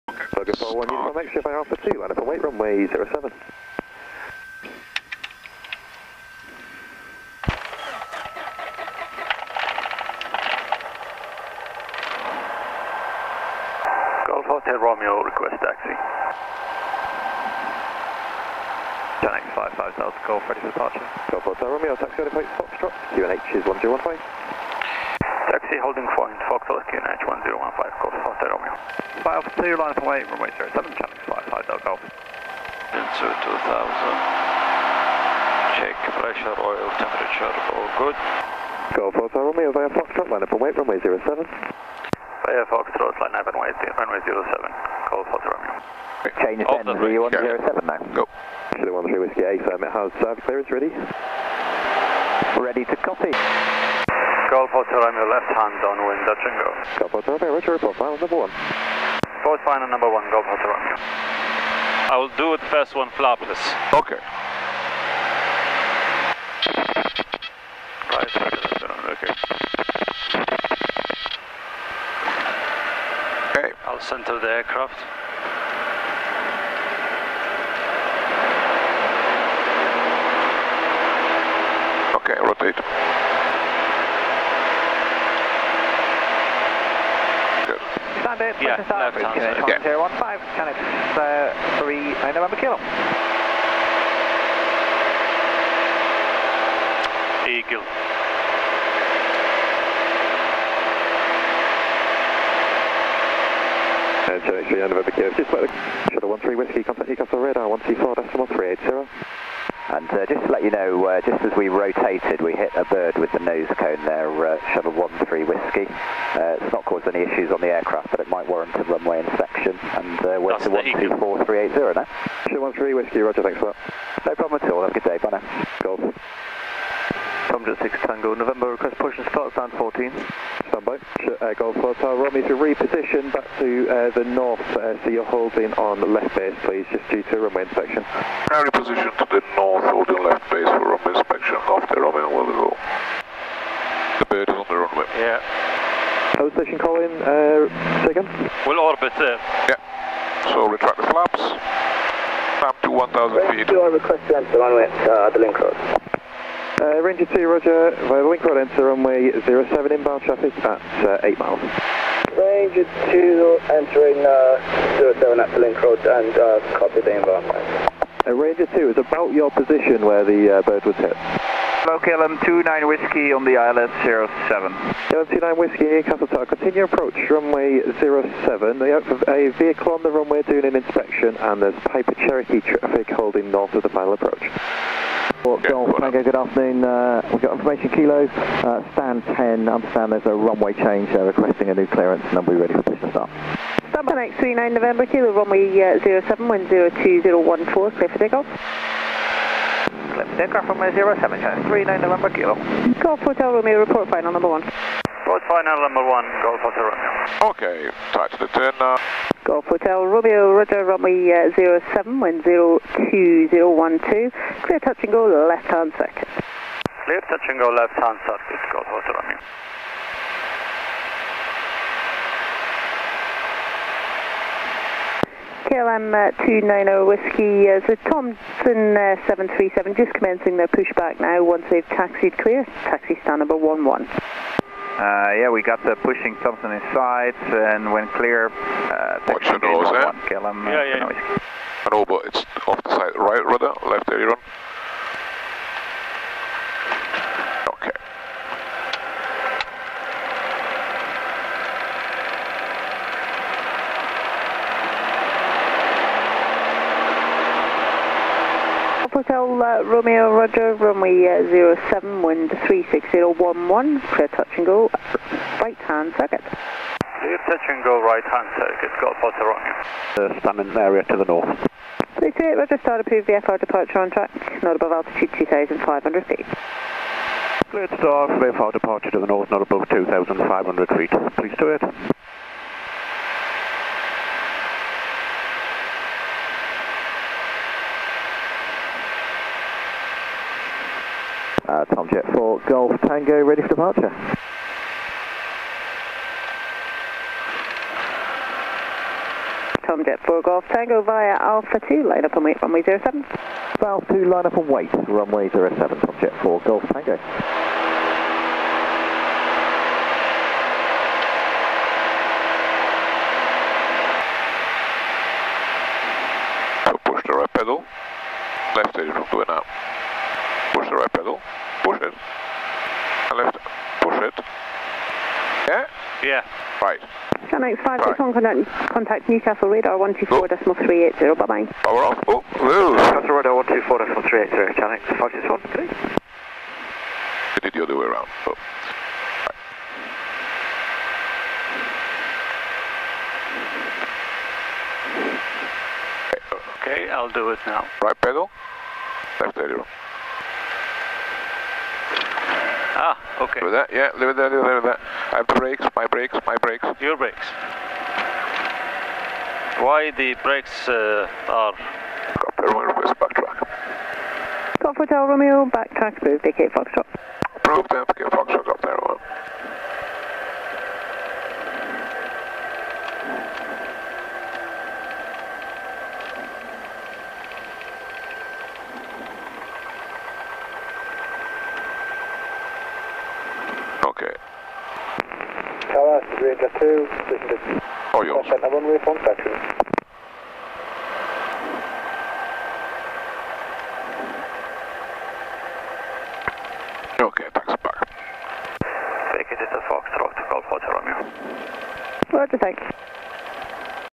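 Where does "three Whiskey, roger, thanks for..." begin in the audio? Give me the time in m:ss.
2:02.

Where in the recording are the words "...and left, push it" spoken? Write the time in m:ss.
5:22.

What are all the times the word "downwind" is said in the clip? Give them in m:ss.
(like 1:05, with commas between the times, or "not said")
0:55.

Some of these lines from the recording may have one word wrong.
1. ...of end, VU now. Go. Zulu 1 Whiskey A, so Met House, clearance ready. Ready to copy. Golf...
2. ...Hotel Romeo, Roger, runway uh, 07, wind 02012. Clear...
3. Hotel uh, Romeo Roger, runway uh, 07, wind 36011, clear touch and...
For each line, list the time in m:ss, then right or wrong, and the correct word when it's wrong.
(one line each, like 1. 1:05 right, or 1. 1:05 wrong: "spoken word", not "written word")
1. 0:46 right
2. 3:29 right
3. 4:19 right.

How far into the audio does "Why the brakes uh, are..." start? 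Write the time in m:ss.
5:59.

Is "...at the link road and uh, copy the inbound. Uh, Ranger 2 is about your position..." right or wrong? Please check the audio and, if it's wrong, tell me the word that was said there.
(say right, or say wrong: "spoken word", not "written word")
right.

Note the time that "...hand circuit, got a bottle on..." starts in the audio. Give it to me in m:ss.
4:28.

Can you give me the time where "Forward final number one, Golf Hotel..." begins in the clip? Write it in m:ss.
0:59.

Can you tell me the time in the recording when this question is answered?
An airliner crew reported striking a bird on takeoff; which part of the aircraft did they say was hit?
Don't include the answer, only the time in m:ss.
1:53.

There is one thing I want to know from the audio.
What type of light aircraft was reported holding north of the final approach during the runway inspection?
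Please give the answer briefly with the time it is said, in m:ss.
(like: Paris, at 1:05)
Piper Cherokee, at 3:01.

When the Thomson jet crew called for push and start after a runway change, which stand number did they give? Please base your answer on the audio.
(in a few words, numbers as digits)
10.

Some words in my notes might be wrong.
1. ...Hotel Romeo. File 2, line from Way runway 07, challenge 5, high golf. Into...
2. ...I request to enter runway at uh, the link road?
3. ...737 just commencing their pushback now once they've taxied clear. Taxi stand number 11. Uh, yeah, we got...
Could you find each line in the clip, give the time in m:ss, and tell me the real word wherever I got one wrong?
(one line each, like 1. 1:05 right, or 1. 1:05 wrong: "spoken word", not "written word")
1. 0:28 right
2. 2:33 right
3. 3:49 right.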